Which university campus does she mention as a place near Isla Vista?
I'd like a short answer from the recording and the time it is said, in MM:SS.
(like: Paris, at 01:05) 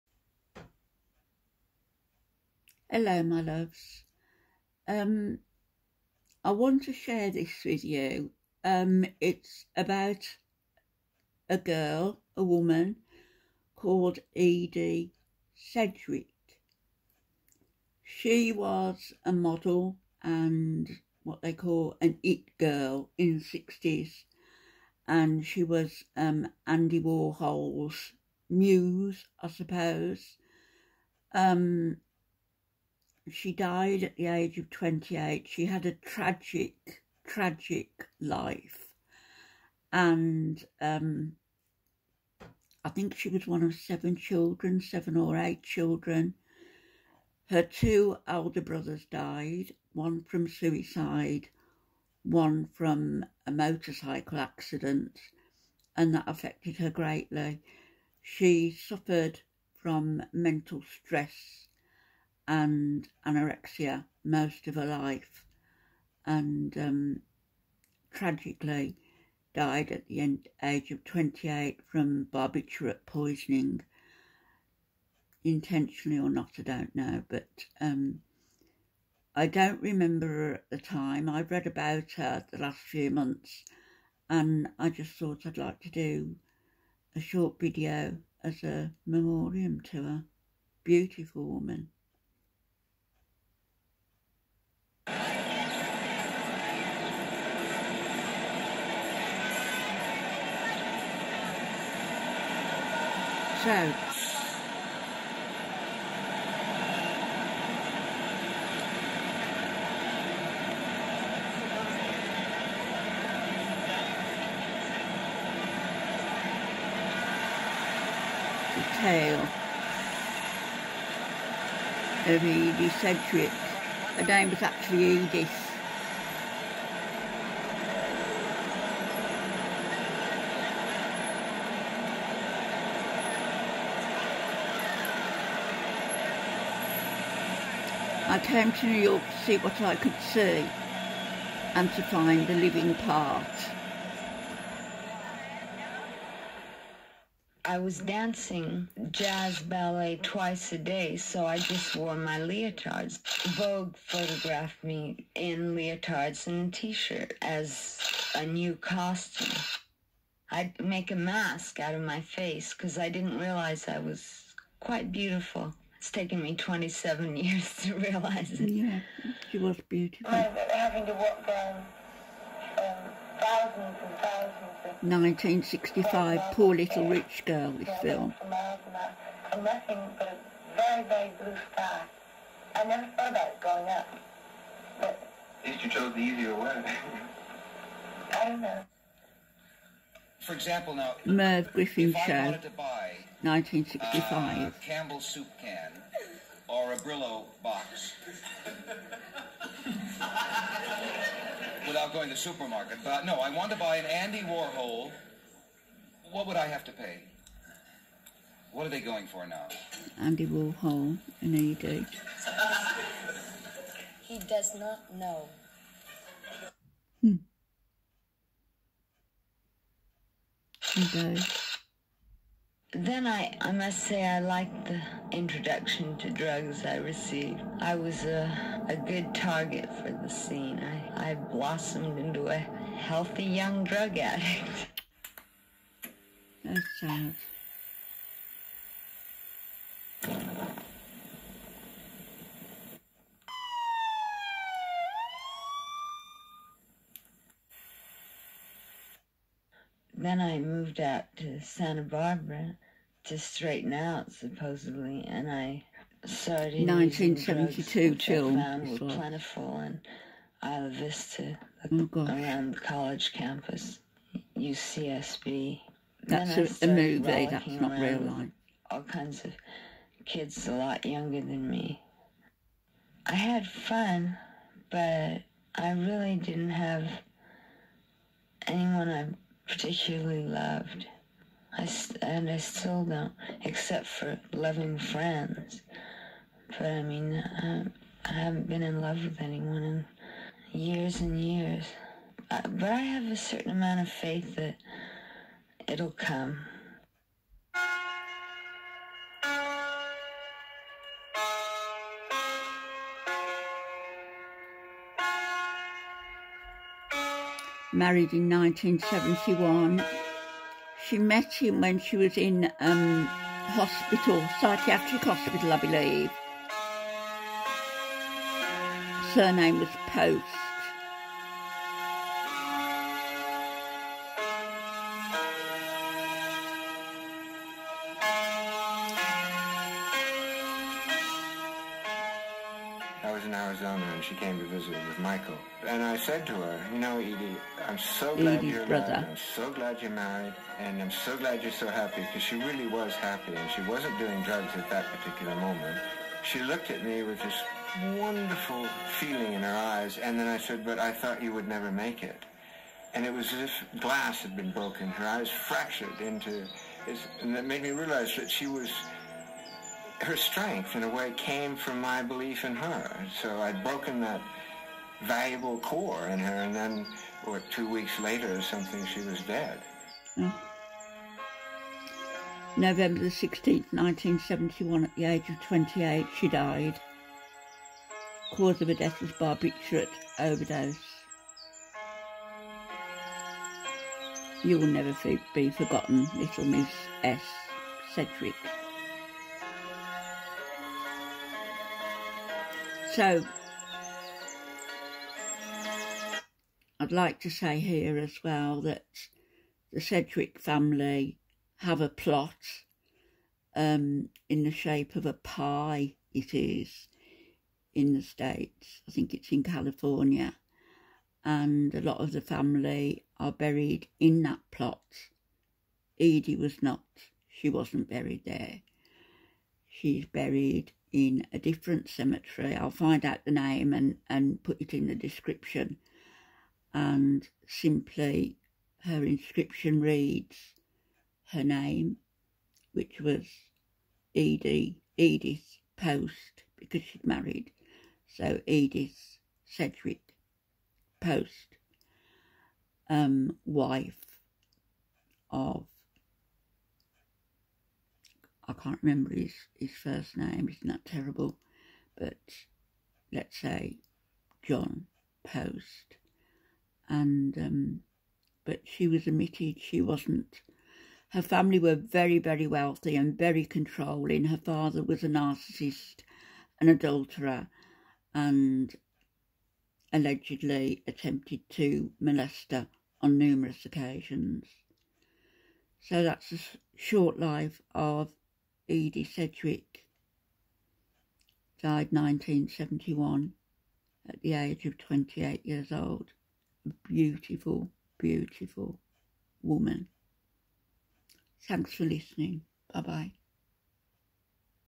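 UCSB, at 04:24.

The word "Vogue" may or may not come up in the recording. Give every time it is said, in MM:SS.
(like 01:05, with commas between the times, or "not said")
02:33.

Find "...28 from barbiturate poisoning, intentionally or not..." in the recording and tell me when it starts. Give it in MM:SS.
01:11.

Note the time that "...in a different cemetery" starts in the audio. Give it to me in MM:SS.
07:01.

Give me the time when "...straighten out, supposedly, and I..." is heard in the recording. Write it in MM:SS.
04:13.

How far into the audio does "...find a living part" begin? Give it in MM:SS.
02:22.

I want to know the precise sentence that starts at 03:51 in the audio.
I, I blossomed into a healthy young drug addict.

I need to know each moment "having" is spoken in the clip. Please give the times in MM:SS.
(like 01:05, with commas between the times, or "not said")
02:50.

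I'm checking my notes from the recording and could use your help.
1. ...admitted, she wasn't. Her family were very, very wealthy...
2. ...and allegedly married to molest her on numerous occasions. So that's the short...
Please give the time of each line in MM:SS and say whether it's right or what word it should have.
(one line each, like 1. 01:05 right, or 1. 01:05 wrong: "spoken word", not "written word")
1. 07:39 right
2. 07:48 wrong: "attempted", not "married".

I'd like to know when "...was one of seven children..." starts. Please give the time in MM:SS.
00:43.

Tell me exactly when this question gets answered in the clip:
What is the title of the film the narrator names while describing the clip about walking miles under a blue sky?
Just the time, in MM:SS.
02:56.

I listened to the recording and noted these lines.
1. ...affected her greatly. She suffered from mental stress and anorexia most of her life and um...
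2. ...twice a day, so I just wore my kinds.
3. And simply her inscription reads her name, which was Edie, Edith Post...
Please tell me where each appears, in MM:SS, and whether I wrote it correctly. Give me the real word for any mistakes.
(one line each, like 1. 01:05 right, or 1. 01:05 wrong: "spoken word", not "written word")
1. 00:56 right
2. 02:30 wrong: "leotards", not "kinds"
3. 07:06 right.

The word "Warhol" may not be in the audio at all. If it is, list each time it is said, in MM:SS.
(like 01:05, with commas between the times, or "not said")
00:27, 03:24, 03:30.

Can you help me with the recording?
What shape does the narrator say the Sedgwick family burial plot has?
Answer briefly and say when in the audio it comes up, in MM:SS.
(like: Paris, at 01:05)
a pie, at 06:45.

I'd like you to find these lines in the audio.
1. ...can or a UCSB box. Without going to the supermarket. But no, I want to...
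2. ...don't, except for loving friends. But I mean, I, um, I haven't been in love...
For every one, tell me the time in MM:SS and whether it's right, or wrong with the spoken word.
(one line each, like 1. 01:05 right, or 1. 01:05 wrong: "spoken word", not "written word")
1. 03:15 wrong: "Brillo", not "UCSB"
2. 04:43 right.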